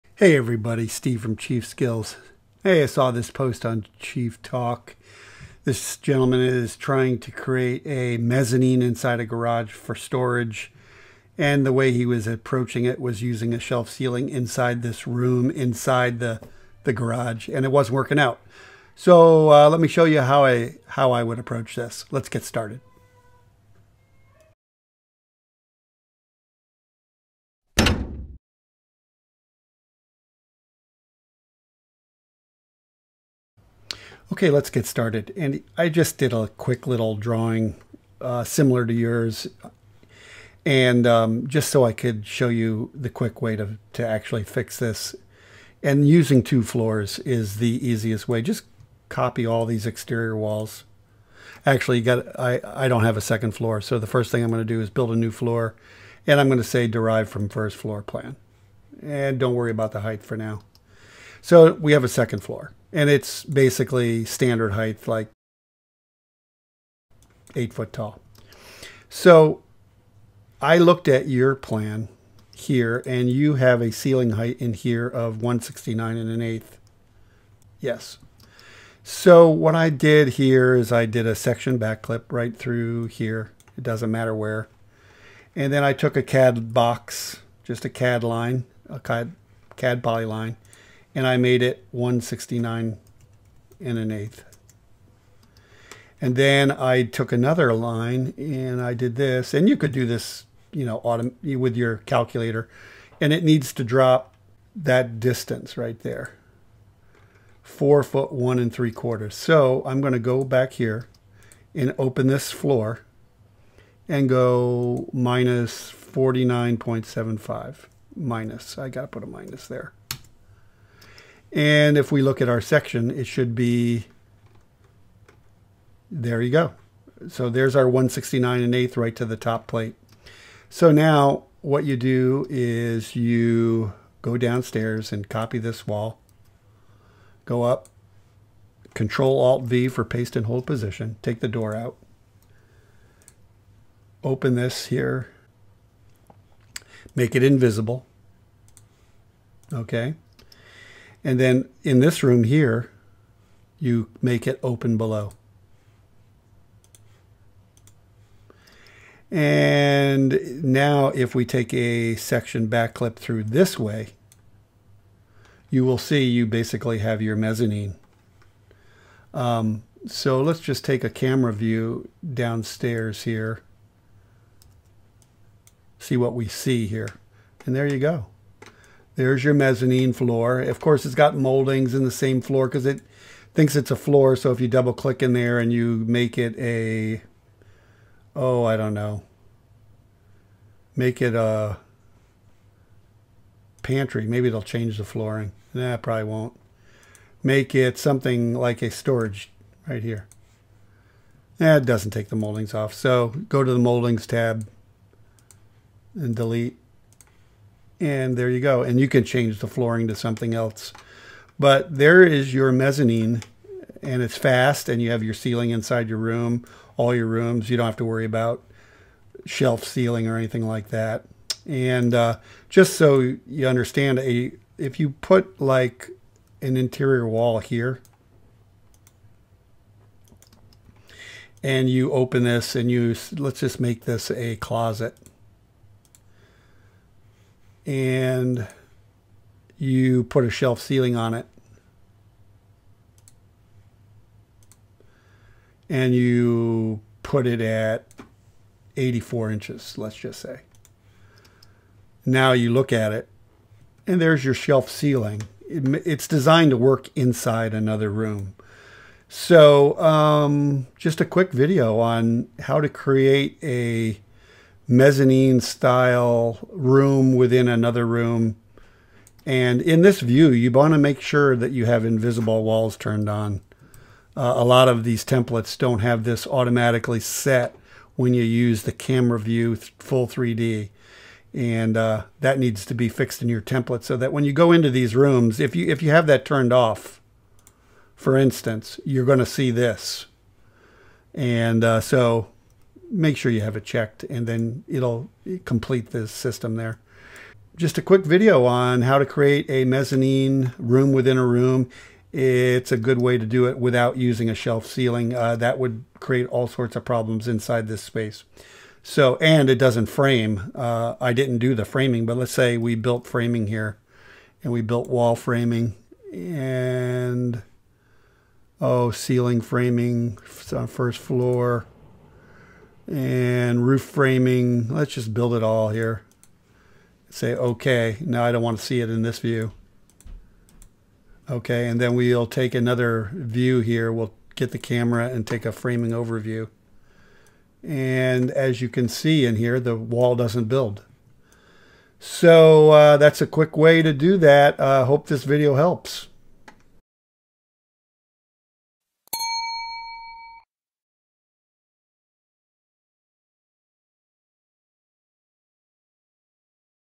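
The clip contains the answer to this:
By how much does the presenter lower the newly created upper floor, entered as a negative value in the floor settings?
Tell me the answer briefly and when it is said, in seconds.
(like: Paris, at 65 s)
49.75, at 115 s.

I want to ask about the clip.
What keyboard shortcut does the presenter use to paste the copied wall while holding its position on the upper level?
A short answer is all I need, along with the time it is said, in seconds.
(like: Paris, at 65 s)
Control Alt V, at 138 s.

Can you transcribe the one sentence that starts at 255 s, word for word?
It, it's designed to work inside another room.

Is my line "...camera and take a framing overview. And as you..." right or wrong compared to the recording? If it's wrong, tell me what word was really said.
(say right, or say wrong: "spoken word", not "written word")
right.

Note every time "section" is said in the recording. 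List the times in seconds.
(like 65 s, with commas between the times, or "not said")
81 s, 122 s, 162 s.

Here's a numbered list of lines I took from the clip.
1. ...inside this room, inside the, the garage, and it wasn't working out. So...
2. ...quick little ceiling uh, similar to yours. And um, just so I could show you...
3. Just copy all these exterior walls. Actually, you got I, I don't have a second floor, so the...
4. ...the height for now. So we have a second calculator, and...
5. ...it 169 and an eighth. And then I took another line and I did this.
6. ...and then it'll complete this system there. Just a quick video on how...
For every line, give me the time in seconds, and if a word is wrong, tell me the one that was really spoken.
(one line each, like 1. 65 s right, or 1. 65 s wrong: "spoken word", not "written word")
1. 14 s right
2. 36 s wrong: "drawing", not "ceiling"
3. 48 s right
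4. 59 s wrong: "floor", not "calculator"
5. 91 s right
6. 294 s right.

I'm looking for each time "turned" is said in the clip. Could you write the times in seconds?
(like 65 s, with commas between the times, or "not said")
272 s, 286 s.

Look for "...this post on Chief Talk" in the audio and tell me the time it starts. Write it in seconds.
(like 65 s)
3 s.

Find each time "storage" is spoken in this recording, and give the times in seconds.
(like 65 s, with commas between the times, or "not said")
9 s, 198 s.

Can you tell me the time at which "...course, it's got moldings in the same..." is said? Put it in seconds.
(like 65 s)
180 s.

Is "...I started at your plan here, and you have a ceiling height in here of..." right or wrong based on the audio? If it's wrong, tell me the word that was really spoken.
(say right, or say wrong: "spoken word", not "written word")
wrong: "looked", not "started".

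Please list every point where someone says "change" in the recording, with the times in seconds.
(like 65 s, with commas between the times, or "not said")
194 s, 209 s.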